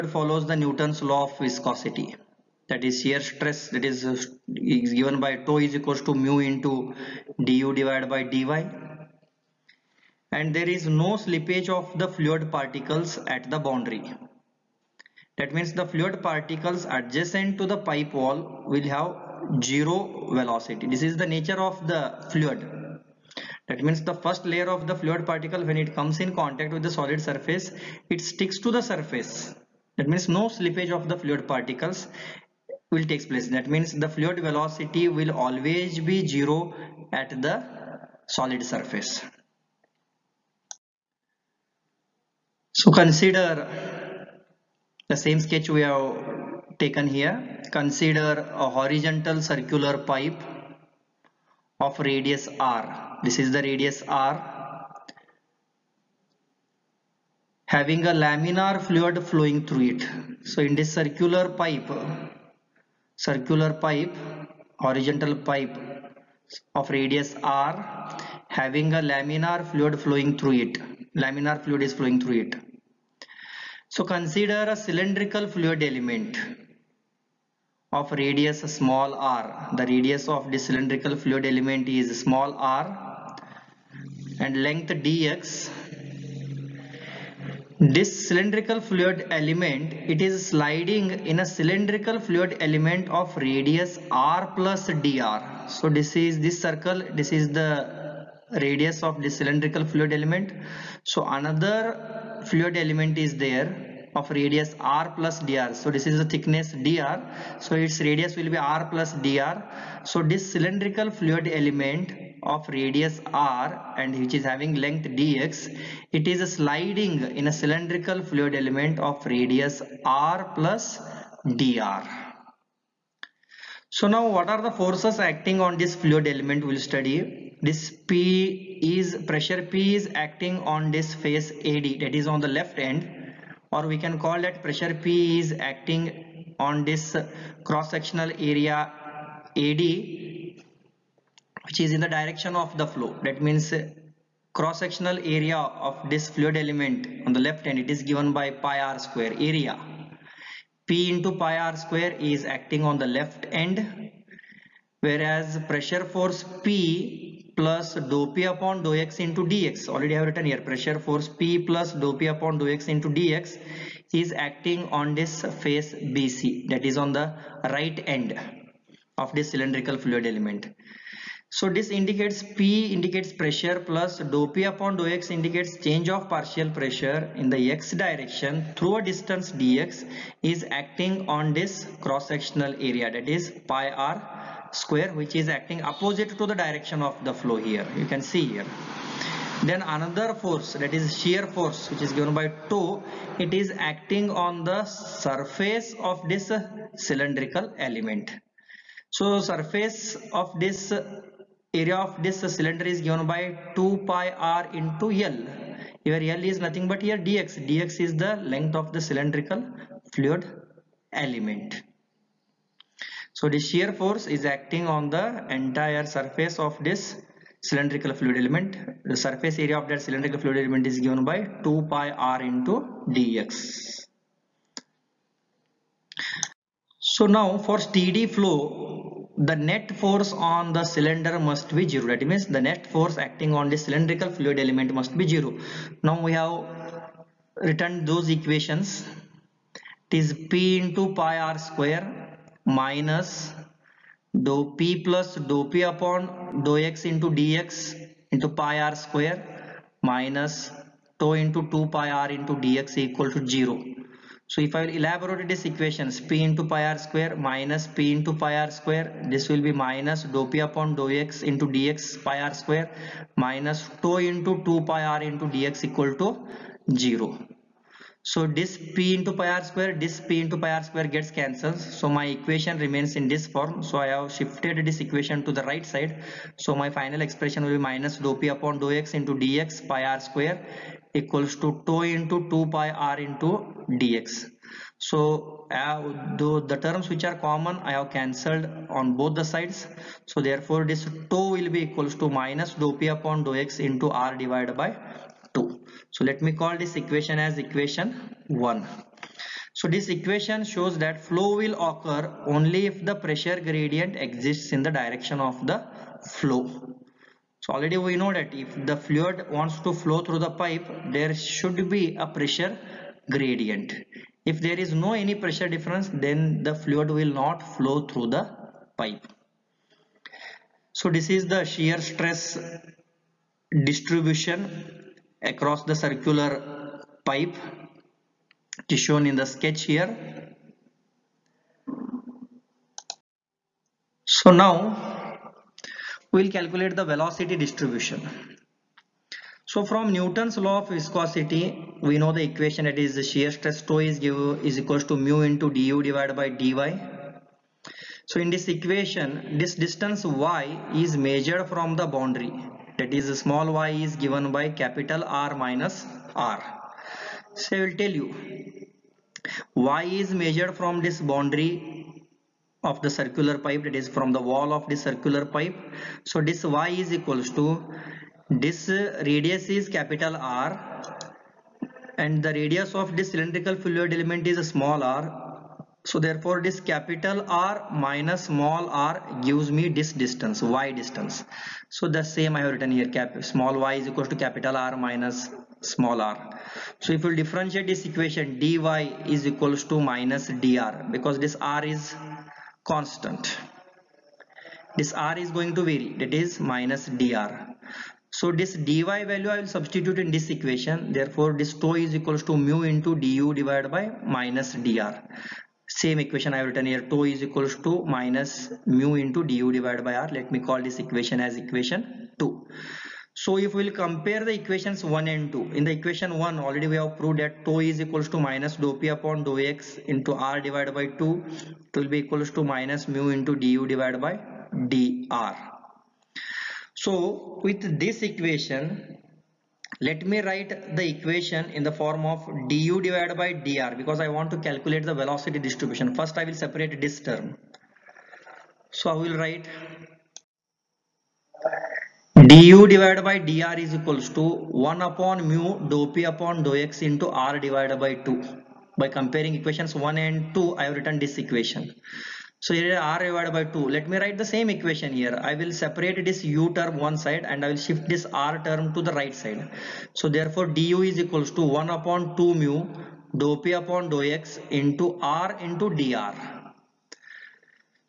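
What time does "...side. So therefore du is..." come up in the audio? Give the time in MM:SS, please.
07:39.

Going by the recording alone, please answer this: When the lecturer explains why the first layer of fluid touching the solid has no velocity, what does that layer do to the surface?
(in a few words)
sticks to the surface.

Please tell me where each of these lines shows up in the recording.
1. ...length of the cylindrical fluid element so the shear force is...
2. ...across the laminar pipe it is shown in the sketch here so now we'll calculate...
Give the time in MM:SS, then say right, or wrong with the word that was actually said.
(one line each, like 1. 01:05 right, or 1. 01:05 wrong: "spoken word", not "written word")
1. 03:28 right
2. 05:25 wrong: "circular", not "laminar".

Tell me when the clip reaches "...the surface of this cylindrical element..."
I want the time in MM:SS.
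03:14.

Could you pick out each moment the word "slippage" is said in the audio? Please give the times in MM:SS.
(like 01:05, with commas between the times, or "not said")
00:11, 00:30.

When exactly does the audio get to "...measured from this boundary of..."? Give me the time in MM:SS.
06:00.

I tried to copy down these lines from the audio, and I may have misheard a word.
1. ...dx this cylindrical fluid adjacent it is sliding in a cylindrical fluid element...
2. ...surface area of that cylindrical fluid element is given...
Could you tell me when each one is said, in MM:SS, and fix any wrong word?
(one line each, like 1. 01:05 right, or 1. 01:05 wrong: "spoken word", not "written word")
1. 01:25 wrong: "element", not "adjacent"
2. 03:39 right.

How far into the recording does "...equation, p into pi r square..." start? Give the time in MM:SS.
04:15.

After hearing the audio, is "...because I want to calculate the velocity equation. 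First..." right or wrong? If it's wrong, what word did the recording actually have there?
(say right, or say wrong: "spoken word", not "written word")
wrong: "distribution", not "equation".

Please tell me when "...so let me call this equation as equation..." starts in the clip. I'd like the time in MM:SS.
04:56.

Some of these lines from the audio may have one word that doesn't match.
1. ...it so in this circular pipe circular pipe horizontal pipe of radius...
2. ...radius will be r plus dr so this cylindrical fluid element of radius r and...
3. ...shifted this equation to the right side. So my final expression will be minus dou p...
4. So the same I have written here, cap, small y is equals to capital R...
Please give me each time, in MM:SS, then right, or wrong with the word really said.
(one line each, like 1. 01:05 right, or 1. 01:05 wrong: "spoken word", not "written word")
1. 00:59 right
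2. 01:48 right
3. 04:34 right
4. 06:21 right.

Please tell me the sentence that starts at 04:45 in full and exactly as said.
So uh, the, the terms which are common I have cancelled on both the sides.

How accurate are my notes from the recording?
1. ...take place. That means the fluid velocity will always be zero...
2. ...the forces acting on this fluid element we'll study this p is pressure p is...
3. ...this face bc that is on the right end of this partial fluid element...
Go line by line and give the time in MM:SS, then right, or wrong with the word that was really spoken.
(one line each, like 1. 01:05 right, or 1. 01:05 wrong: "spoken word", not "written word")
1. 00:33 right
2. 02:04 right
3. 02:45 wrong: "cylindrical", not "partial".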